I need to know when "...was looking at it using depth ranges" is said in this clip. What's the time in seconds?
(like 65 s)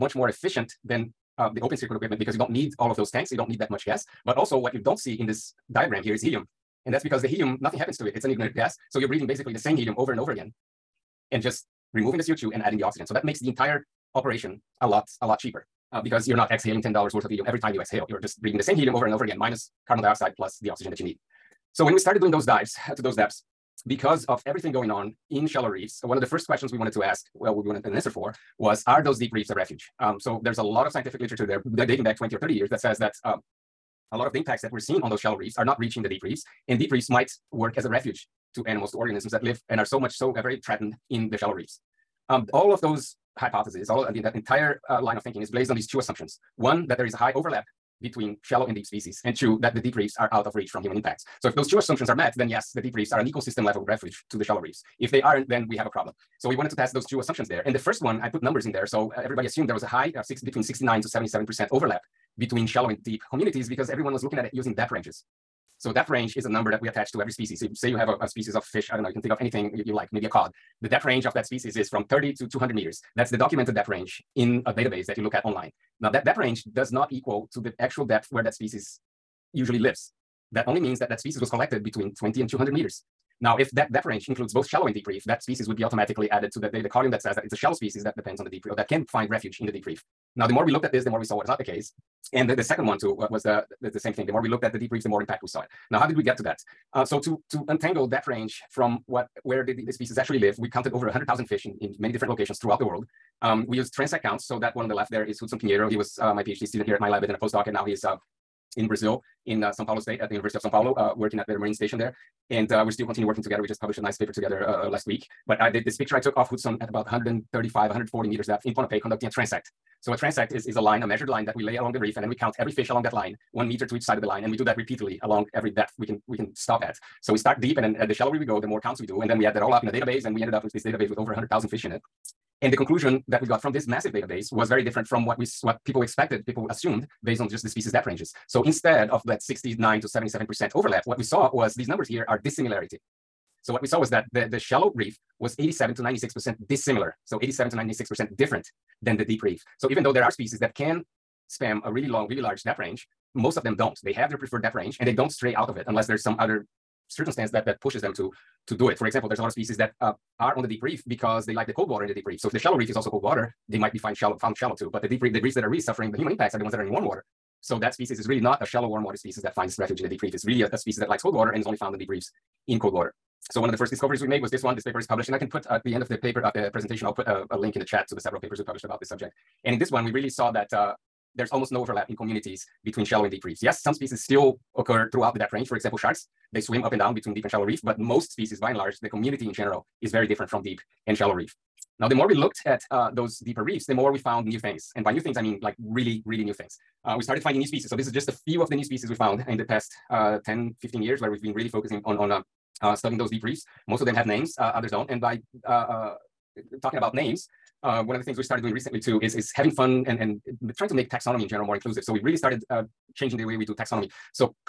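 64 s.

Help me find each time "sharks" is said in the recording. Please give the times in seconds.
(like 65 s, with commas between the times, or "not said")
185 s.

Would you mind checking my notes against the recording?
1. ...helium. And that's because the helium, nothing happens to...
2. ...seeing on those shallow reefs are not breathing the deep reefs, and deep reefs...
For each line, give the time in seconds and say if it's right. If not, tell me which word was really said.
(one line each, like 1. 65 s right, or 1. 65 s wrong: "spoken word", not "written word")
1. 6 s right
2. 34 s wrong: "reaching", not "breathing".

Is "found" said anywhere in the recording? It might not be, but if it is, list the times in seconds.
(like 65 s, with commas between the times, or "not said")
164 s, 171 s, 194 s, 199 s.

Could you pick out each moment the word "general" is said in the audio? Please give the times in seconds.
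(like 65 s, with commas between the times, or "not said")
189 s, 211 s.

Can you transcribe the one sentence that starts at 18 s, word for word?
You're just breathing the same helium over and over again, minus carbon dioxide plus the oxygen that you need.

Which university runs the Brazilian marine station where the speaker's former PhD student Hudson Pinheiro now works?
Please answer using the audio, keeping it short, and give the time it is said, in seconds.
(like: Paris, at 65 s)
University of Sao Paulo, at 110 s.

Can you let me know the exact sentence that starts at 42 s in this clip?
Um, all of those hypotheses, all and the, that entire uh, line of thinking is based on these two assumptions.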